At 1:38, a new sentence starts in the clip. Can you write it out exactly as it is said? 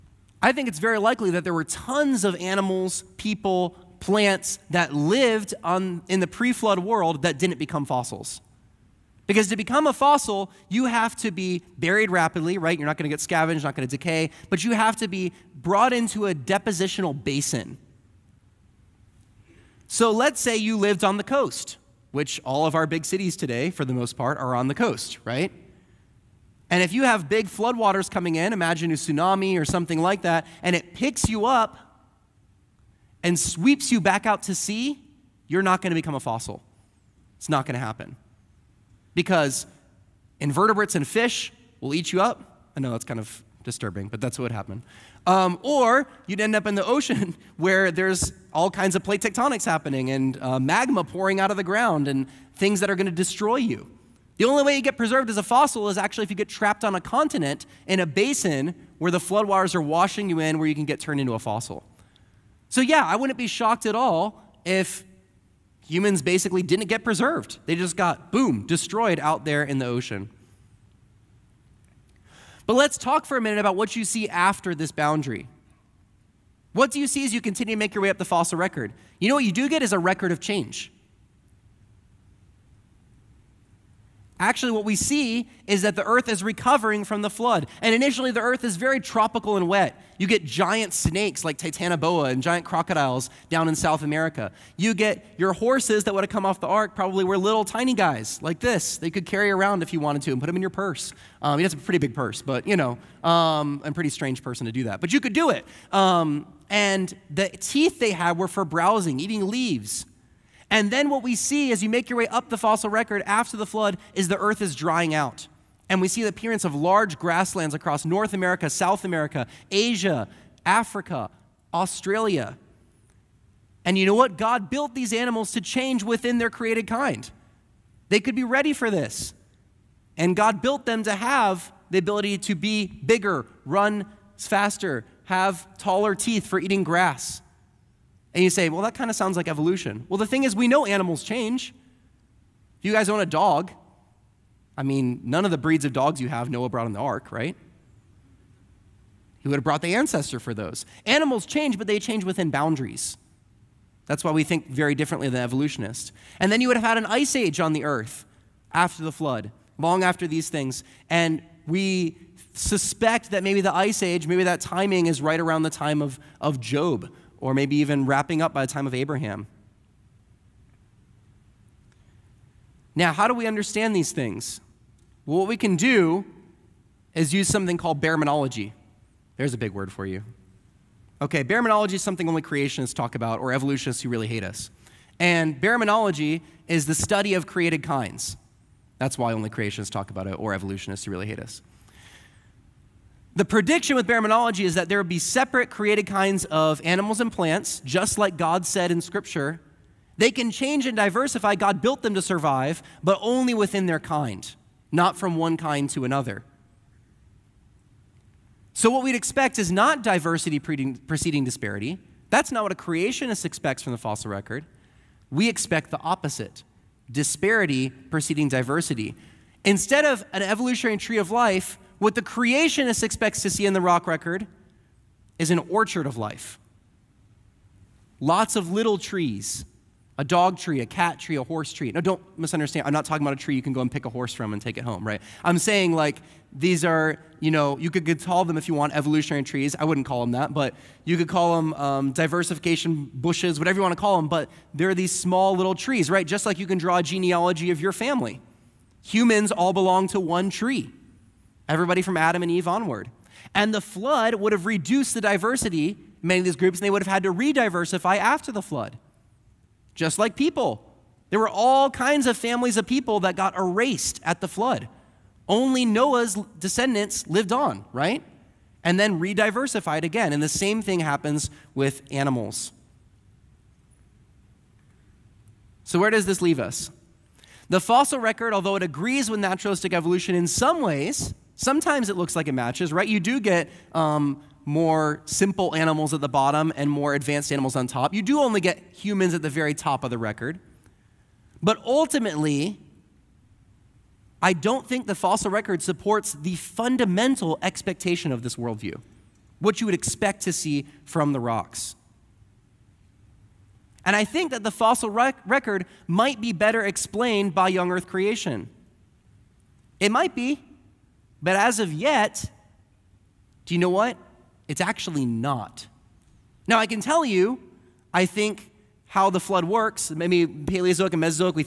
They could carry around if you wanted to and put them in your purse.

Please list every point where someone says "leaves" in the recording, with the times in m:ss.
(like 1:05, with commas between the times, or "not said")
1:49, 4:36.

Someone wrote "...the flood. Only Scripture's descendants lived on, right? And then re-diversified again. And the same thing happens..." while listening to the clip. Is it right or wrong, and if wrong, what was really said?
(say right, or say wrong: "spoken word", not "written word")
wrong: "Noah", not "Scripture".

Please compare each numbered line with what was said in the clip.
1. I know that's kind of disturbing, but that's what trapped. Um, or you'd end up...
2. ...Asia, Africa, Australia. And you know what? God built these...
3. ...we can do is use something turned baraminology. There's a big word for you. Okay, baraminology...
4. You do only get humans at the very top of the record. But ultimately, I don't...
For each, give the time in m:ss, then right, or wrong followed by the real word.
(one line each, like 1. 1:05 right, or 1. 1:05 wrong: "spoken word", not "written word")
1. 0:42 wrong: "happened", not "trapped"
2. 1:59 right
3. 2:55 wrong: "called", not "turned"
4. 4:48 right.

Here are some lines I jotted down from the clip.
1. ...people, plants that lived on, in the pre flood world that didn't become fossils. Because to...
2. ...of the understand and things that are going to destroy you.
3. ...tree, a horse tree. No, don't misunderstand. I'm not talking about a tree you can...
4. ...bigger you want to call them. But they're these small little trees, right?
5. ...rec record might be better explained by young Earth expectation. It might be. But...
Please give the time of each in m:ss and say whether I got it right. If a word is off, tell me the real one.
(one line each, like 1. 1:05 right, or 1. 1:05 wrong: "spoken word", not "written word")
1. 0:03 right
2. 0:51 wrong: "ground", not "understand"
3. 3:51 right
4. 4:03 wrong: "whatever", not "bigger"
5. 5:05 wrong: "creation", not "expectation".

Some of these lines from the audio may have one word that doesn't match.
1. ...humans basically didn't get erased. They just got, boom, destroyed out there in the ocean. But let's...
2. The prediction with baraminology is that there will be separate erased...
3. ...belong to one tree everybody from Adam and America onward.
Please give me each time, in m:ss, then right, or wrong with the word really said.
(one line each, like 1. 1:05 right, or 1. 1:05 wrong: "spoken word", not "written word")
1. 1:05 wrong: "preserved", not "erased"
2. 3:13 wrong: "created", not "erased"
3. 4:09 wrong: "Eve", not "America".